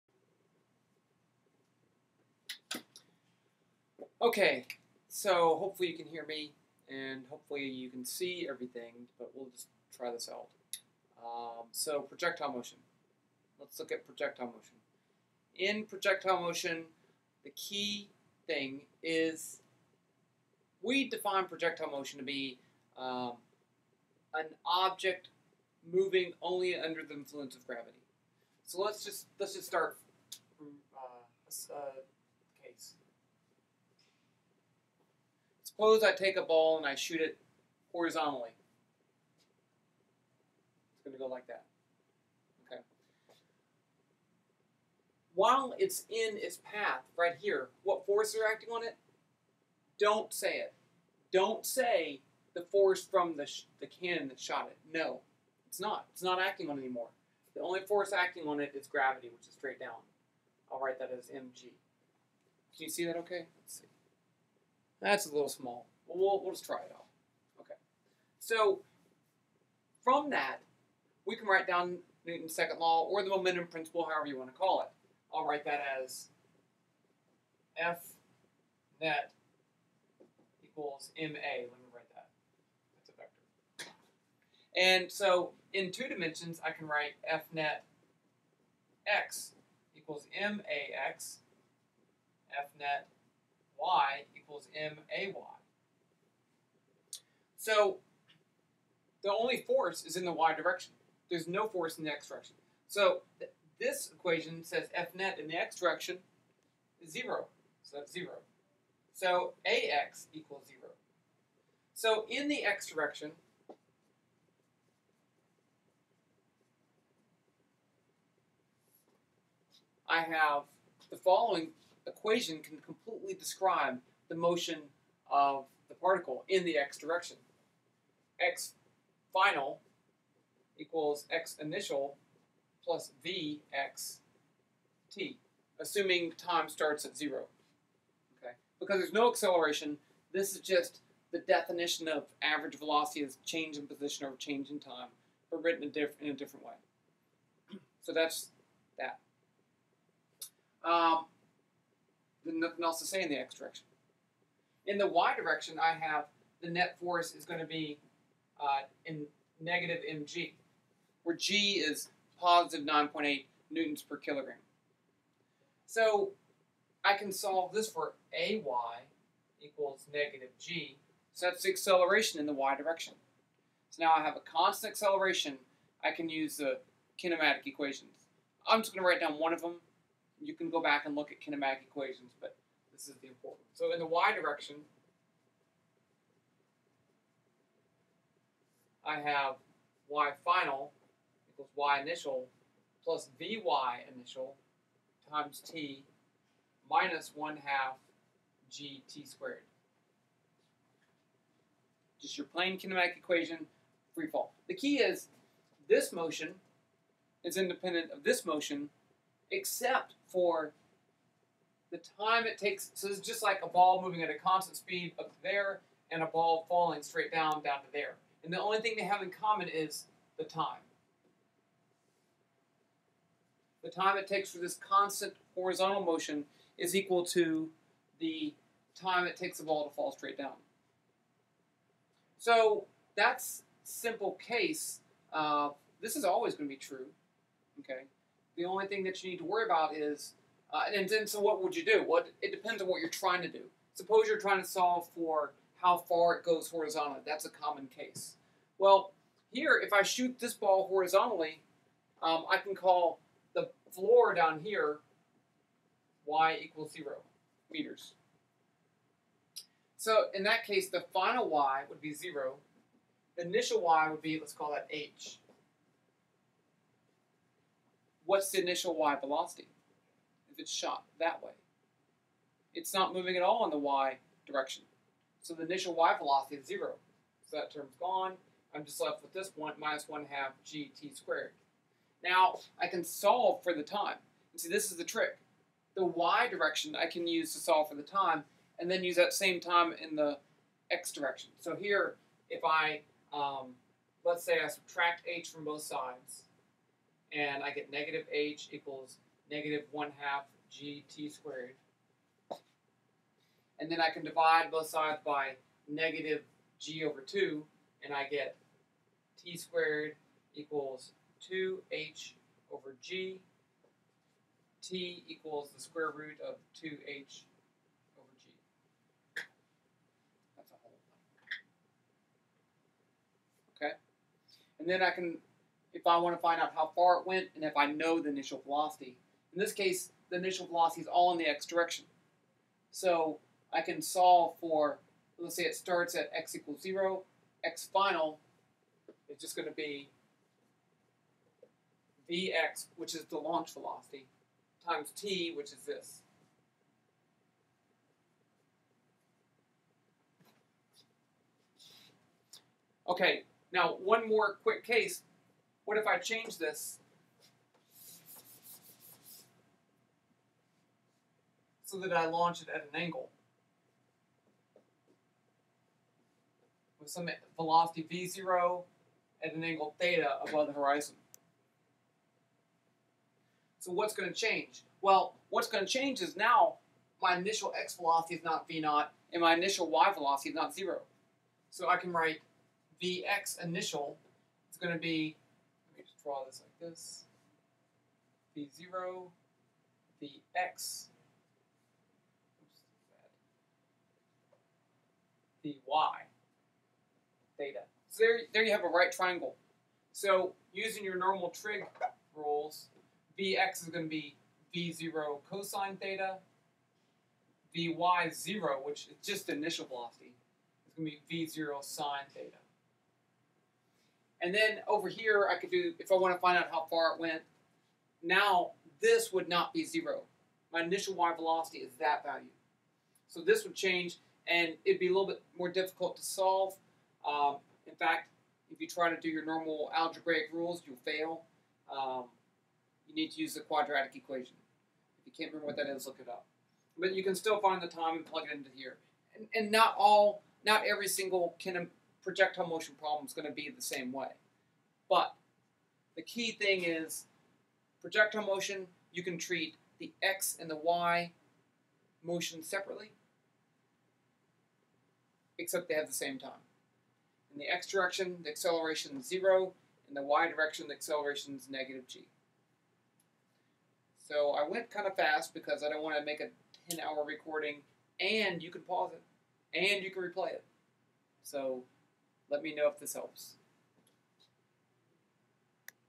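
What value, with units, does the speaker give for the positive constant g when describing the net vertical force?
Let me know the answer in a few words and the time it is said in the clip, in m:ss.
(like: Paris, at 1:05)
9.8 newtons per kilogram, at 2:42.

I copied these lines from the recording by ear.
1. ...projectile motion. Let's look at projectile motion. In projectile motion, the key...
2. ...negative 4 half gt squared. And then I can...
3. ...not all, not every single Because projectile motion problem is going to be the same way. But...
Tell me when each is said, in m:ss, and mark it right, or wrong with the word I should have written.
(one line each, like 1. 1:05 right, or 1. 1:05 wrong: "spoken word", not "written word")
1. 0:12 right
2. 4:59 wrong: "1", not "4"
3. 7:19 wrong: "Kenham", not "Because".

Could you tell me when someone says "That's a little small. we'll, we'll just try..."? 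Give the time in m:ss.
1:05.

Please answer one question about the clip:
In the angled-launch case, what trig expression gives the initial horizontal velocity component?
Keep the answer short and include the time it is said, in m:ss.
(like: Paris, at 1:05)
V0 cosine theta, at 6:44.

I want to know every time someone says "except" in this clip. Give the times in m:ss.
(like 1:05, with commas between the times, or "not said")
3:29, 7:35.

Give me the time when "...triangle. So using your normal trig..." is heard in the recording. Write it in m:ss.
6:39.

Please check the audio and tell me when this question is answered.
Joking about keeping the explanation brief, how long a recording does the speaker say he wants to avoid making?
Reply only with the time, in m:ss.
7:46.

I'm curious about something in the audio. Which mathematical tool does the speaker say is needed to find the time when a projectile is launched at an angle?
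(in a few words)
quadratic equation.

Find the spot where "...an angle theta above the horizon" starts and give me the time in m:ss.
6:09.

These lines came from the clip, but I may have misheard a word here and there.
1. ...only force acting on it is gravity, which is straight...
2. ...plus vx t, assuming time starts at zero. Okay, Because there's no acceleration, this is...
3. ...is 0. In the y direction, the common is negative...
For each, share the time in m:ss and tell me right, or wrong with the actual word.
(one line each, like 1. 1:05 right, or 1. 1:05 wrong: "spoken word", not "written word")
1. 0:57 right
2. 2:12 right
3. 7:39 wrong: "acceleration", not "common".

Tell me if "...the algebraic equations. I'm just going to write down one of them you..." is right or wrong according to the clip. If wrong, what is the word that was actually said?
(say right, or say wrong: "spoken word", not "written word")
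wrong: "kinematic", not "algebraic".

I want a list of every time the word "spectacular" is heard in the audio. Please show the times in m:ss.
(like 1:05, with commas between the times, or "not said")
not said.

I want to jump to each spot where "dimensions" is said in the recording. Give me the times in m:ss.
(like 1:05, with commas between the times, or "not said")
1:26.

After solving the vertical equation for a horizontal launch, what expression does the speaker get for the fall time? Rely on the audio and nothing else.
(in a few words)
square root of 2h over g.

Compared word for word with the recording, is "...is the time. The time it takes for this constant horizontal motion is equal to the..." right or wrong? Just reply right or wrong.
right.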